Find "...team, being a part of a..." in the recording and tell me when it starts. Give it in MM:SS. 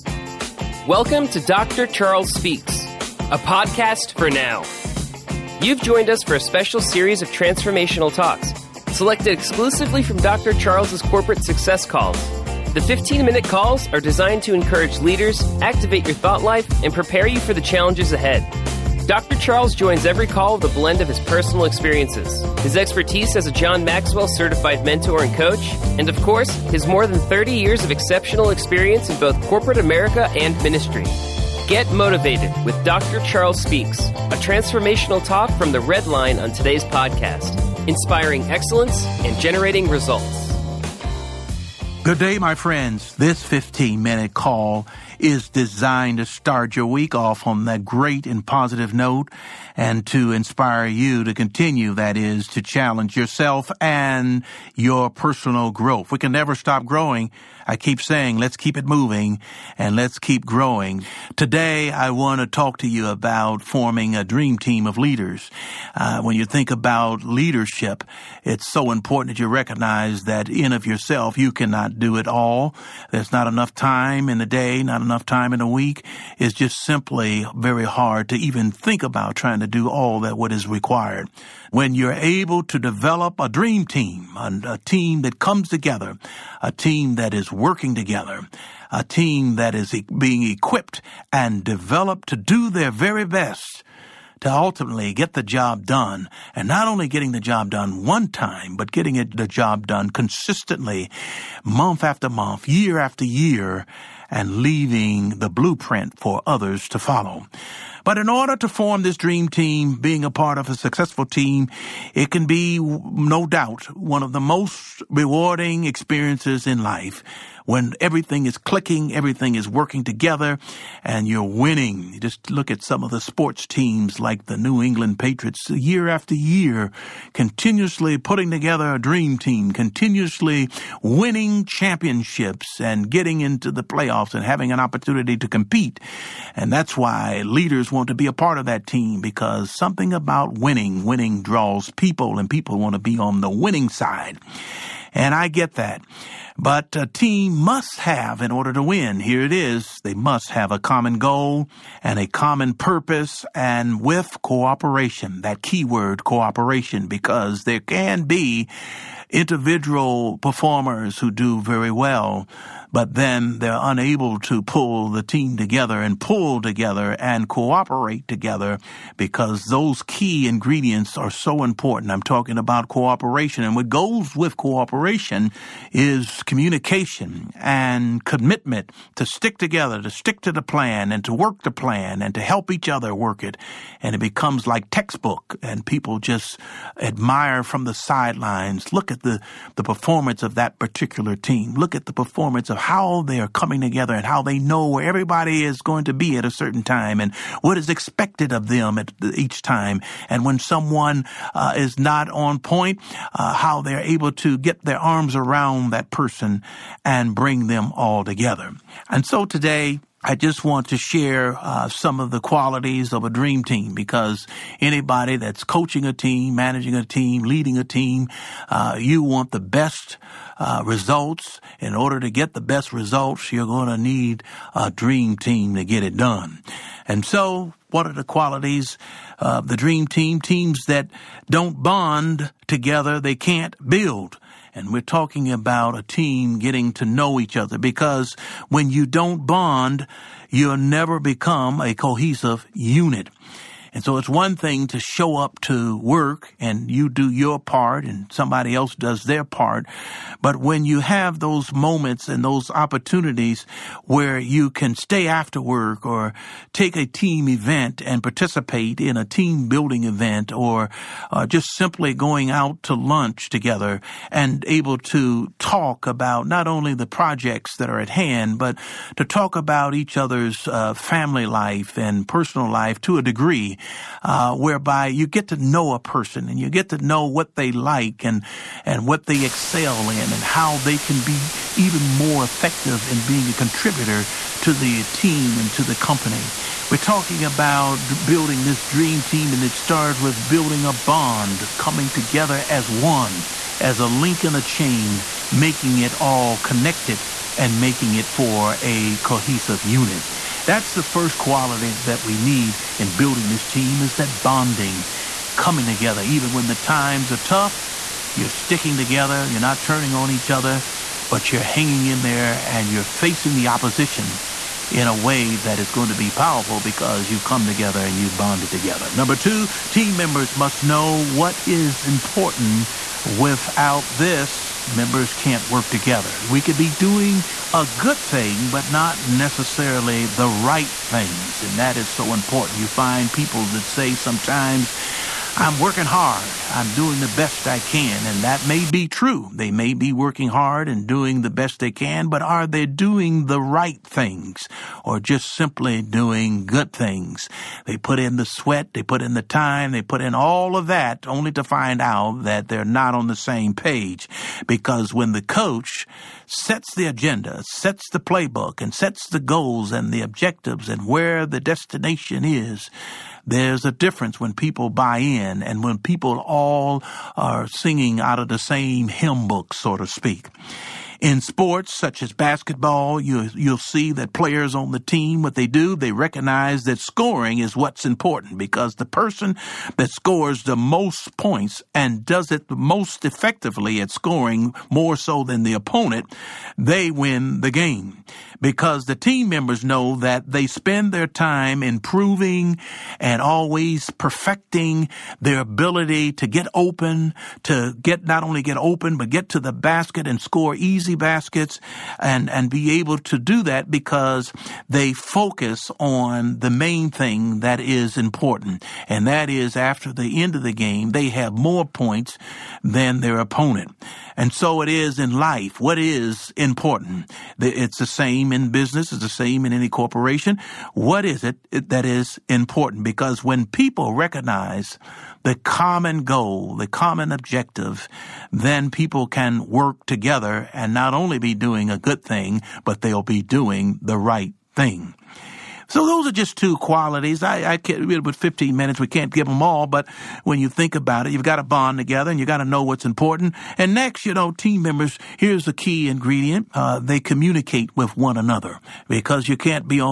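01:49.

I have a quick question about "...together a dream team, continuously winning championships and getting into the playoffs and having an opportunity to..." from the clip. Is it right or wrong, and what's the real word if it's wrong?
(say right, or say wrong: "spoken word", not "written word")
right.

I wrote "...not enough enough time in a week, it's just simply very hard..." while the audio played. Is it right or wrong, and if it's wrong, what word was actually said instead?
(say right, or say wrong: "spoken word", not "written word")
right.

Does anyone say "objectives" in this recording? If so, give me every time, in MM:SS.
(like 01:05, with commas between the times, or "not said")
06:00, 07:07.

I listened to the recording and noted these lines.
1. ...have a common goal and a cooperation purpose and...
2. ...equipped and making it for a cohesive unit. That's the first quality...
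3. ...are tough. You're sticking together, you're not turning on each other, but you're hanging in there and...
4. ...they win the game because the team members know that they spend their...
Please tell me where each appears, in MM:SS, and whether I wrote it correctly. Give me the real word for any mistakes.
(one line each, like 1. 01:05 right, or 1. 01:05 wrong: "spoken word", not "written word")
1. 02:30 wrong: "common", not "cooperation"
2. 04:56 wrong: "connected", not "equipped"
3. 05:07 right
4. 06:26 right.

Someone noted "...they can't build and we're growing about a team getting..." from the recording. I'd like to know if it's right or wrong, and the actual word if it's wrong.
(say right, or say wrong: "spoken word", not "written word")
wrong: "talking", not "growing".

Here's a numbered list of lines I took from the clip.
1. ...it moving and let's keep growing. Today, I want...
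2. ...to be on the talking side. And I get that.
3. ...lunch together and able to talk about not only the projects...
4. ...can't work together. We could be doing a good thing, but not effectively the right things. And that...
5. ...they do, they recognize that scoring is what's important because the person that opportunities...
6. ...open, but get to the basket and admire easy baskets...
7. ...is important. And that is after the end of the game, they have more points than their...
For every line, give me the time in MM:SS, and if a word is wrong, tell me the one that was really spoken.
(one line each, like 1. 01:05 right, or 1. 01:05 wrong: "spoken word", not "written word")
1. 00:58 right
2. 02:22 wrong: "winning", not "talking"
3. 04:22 right
4. 05:25 wrong: "necessarily", not "effectively"
5. 06:15 wrong: "scores", not "opportunities"
6. 06:38 wrong: "score", not "admire"
7. 06:47 right.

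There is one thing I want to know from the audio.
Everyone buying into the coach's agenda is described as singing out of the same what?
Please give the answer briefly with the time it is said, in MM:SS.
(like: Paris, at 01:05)
hymn book, at 06:09.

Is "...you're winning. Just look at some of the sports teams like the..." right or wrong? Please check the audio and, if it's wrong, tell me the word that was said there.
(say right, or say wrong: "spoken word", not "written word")
right.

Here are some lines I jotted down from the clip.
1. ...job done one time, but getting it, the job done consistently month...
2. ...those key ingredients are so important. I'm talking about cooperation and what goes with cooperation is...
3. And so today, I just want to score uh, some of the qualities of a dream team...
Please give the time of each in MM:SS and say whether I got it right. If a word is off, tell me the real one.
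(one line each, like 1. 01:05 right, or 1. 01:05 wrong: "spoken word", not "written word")
1. 01:37 right
2. 02:49 right
3. 03:29 wrong: "share", not "score".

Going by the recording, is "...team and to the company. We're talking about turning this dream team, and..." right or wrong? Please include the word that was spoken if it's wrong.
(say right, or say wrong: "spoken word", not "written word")
wrong: "building", not "turning".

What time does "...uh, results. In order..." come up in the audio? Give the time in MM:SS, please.
03:40.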